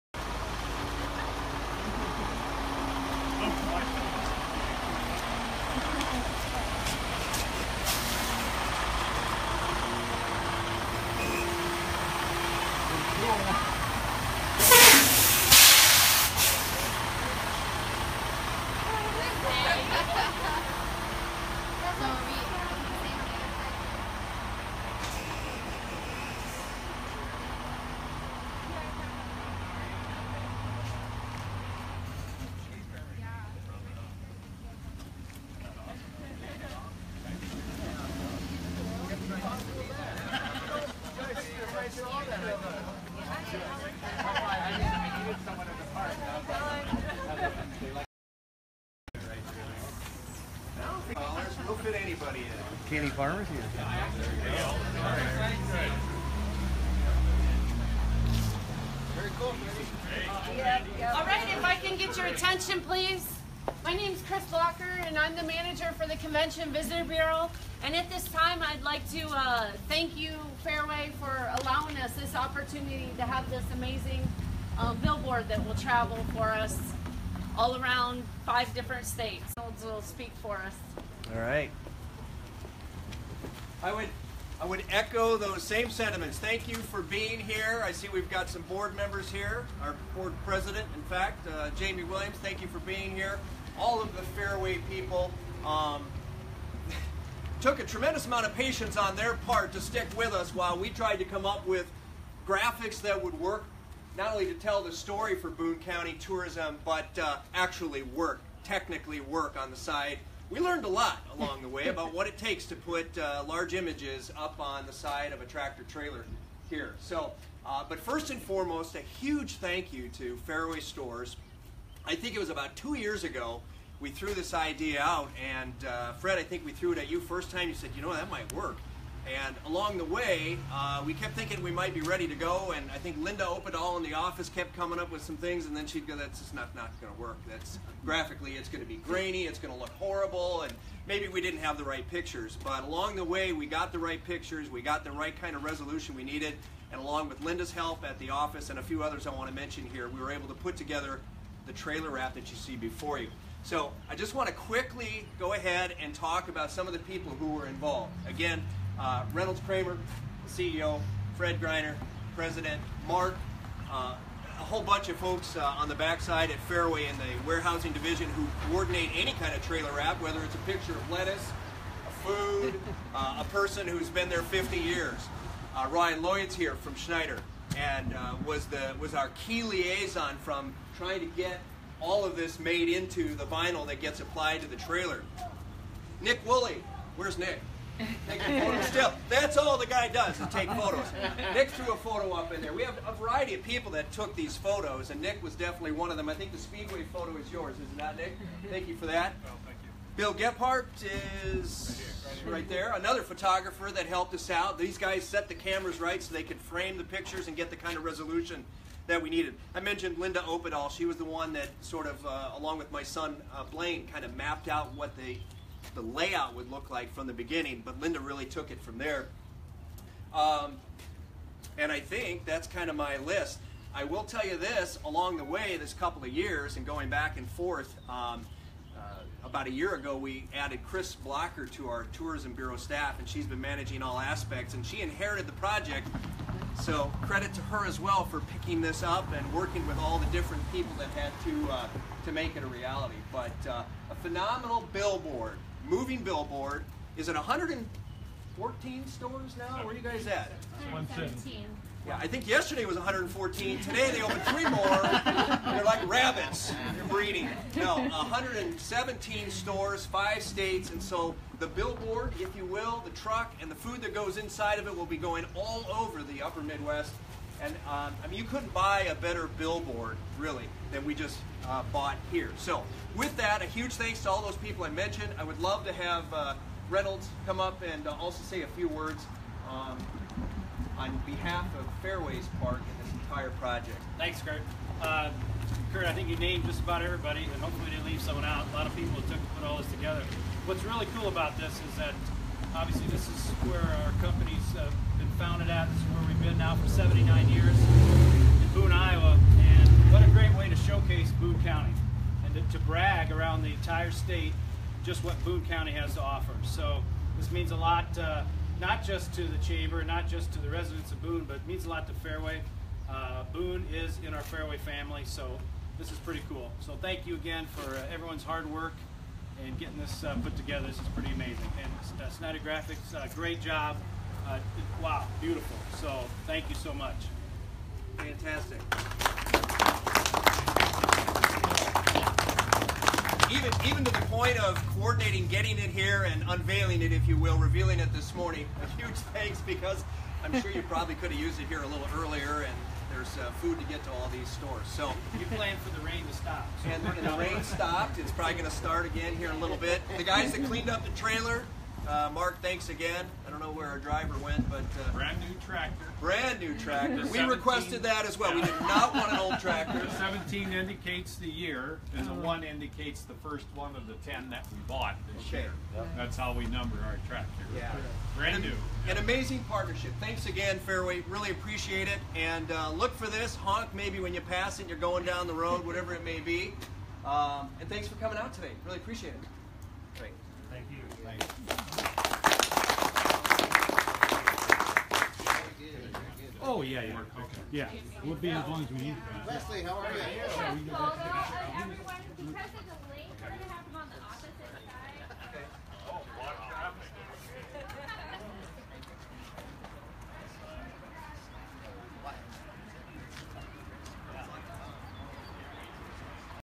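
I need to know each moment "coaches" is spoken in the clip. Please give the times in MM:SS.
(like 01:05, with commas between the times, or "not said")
not said.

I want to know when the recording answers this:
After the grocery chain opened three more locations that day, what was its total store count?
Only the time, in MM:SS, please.
04:18.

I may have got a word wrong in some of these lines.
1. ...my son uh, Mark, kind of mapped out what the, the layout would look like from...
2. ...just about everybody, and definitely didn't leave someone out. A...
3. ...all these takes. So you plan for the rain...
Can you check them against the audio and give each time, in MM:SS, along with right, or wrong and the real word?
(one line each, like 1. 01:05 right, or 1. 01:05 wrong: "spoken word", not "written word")
1. 03:32 wrong: "Blaine", not "Mark"
2. 04:46 wrong: "hopefully", not "definitely"
3. 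05:44 wrong: "stores", not "takes".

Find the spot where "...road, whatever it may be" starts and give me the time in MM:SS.
06:15.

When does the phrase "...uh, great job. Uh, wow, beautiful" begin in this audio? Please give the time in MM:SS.
05:23.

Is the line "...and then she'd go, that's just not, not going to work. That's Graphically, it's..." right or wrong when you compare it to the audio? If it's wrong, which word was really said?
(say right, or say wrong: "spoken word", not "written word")
right.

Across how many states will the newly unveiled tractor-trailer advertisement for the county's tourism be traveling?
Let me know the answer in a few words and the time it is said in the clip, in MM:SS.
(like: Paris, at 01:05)
5, at 01:18.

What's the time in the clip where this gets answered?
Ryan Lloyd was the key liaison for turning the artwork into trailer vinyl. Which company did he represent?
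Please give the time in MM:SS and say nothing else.
02:56.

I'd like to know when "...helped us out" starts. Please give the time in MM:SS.
03:24.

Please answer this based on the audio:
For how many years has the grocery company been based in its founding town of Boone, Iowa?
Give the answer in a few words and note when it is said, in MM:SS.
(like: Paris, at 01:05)
79, at 04:56.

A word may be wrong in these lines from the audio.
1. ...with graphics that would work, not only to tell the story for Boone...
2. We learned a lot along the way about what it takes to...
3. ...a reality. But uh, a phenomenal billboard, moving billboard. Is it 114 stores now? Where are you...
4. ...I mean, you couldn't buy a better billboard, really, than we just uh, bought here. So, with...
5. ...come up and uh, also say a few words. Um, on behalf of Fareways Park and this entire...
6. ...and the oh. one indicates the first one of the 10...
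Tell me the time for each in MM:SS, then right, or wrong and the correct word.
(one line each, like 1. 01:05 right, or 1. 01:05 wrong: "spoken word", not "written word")
1. 01:41 right
2. 01:50 right
3. 04:02 right
4. 04:28 right
5. 04:37 right
6. 06:02 right.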